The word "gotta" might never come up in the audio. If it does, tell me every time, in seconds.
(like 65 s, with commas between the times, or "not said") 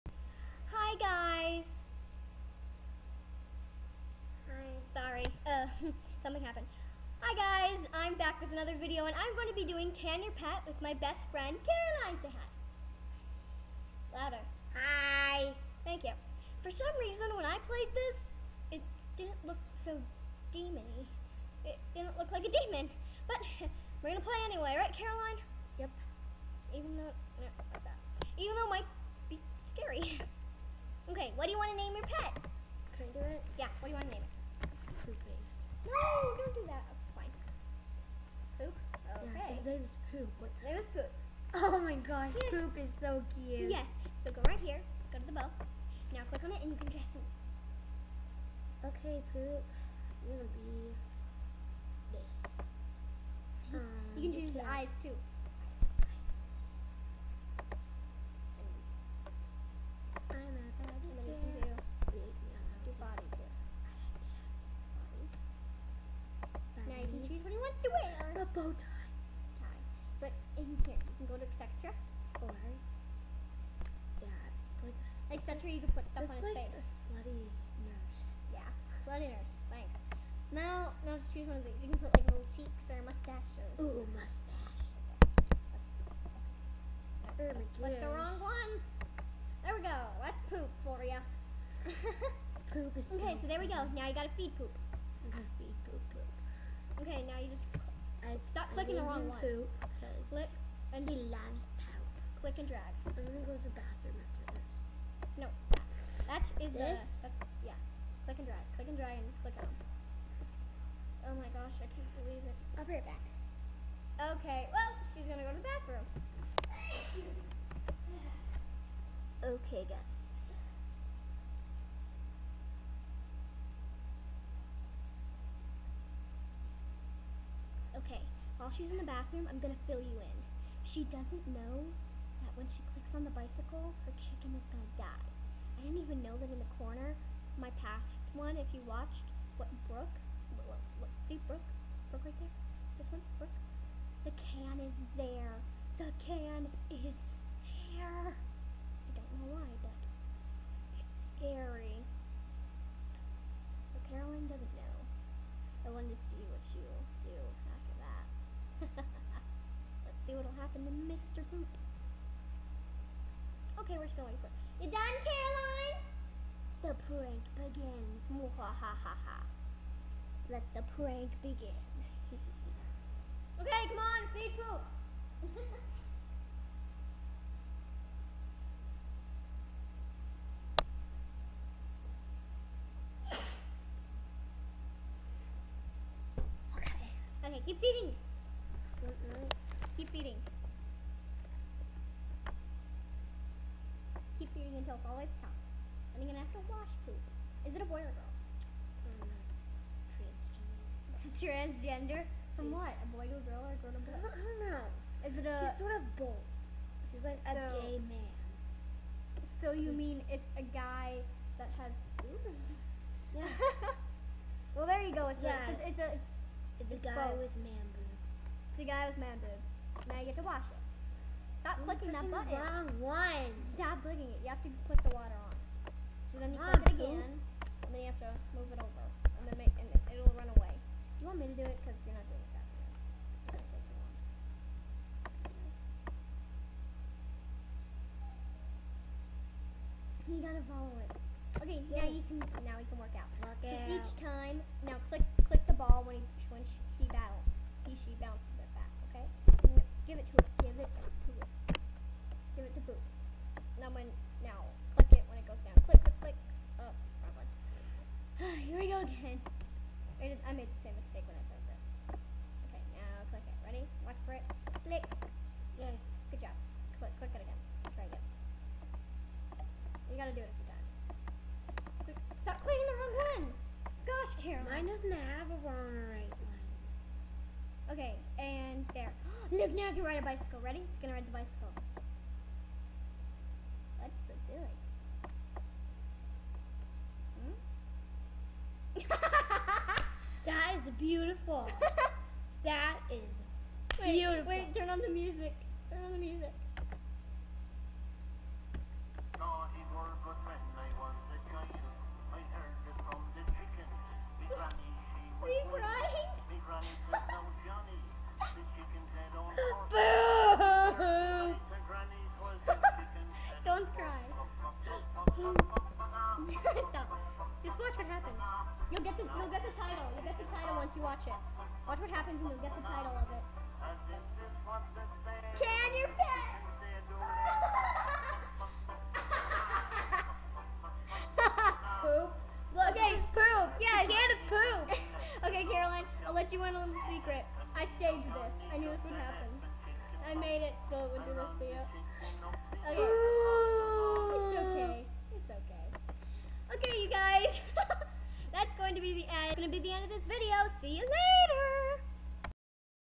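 94 s, 240 s, 270 s.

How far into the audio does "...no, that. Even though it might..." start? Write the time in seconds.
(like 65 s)
27 s.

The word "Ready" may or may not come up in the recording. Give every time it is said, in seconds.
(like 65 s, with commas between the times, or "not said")
263 s, 280 s.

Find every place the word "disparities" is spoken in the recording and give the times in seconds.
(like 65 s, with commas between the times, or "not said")
not said.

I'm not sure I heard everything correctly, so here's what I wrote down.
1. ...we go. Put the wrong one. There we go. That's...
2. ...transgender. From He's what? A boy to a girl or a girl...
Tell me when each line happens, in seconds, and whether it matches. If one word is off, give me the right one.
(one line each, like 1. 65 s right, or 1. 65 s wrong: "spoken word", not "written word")
1. 87 s right
2. 201 s right.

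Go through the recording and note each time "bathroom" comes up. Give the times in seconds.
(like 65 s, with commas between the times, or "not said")
103 s, 115 s, 129 s.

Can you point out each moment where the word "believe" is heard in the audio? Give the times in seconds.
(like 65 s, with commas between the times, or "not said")
112 s.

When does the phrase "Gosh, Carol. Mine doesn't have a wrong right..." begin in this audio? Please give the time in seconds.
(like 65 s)
274 s.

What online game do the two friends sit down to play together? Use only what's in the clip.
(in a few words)
Can Your Pet.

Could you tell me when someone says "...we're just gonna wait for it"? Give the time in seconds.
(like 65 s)
163 s.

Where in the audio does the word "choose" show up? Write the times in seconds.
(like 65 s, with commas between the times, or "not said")
54 s, 67 s, 81 s.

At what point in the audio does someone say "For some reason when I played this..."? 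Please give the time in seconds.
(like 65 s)
16 s.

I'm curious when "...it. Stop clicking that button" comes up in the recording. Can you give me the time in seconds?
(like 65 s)
220 s.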